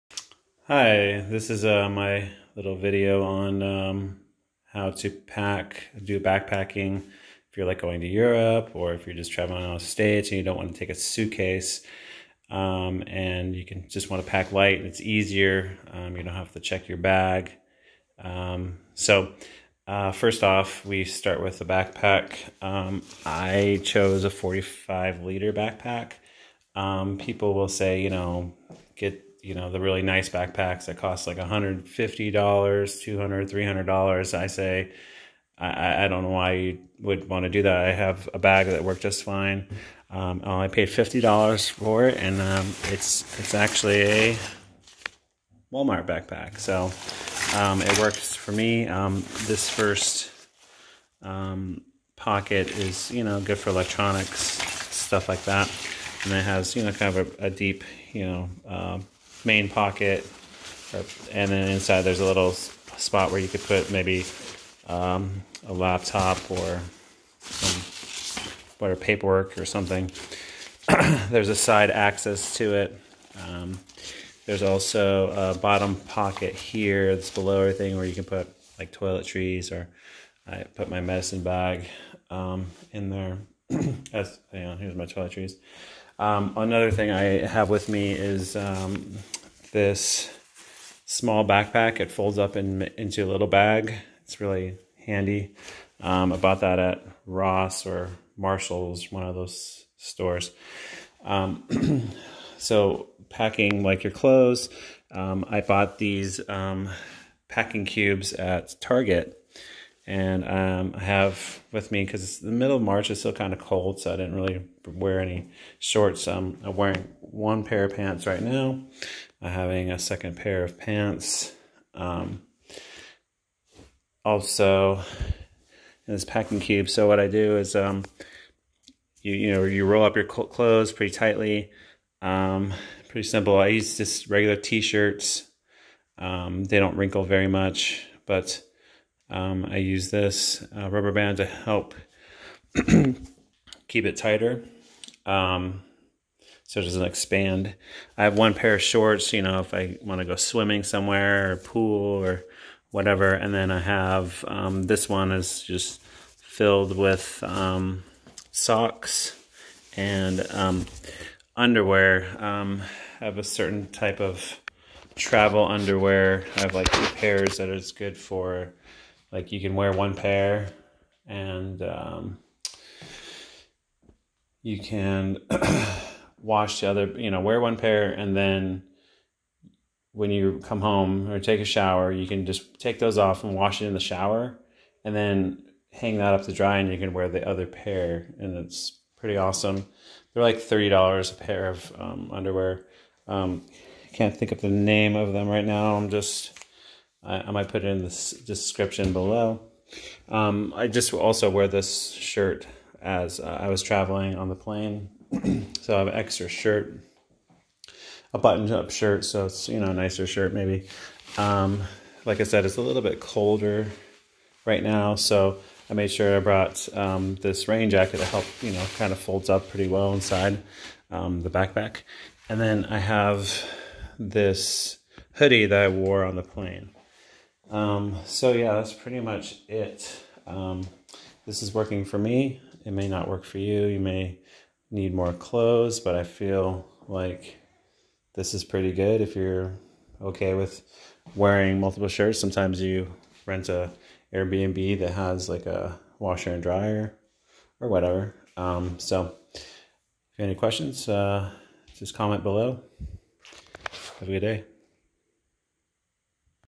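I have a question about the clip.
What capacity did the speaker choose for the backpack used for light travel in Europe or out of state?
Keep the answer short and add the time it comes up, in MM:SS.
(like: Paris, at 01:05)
45 liters, at 00:24.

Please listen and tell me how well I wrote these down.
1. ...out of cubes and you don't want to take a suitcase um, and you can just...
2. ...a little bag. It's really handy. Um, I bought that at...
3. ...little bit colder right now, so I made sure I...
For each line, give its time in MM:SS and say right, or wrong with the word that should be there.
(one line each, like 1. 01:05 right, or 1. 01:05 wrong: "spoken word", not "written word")
1. 00:09 wrong: "states", not "cubes"
2. 01:33 right
3. 03:32 right.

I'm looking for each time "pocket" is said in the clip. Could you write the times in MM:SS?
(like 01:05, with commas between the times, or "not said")
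00:52, 00:59, 01:15.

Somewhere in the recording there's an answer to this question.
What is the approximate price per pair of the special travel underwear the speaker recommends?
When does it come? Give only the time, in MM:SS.
03:10.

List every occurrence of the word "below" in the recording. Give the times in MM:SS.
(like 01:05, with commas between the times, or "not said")
01:17, 03:19, 04:12.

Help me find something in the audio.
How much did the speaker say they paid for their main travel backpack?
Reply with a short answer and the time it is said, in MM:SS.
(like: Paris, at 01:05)
$50, at 00:40.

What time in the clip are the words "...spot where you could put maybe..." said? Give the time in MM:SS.
01:02.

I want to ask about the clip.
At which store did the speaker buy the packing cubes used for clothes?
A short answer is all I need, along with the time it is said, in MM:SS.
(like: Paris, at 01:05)
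Target, at 01:48.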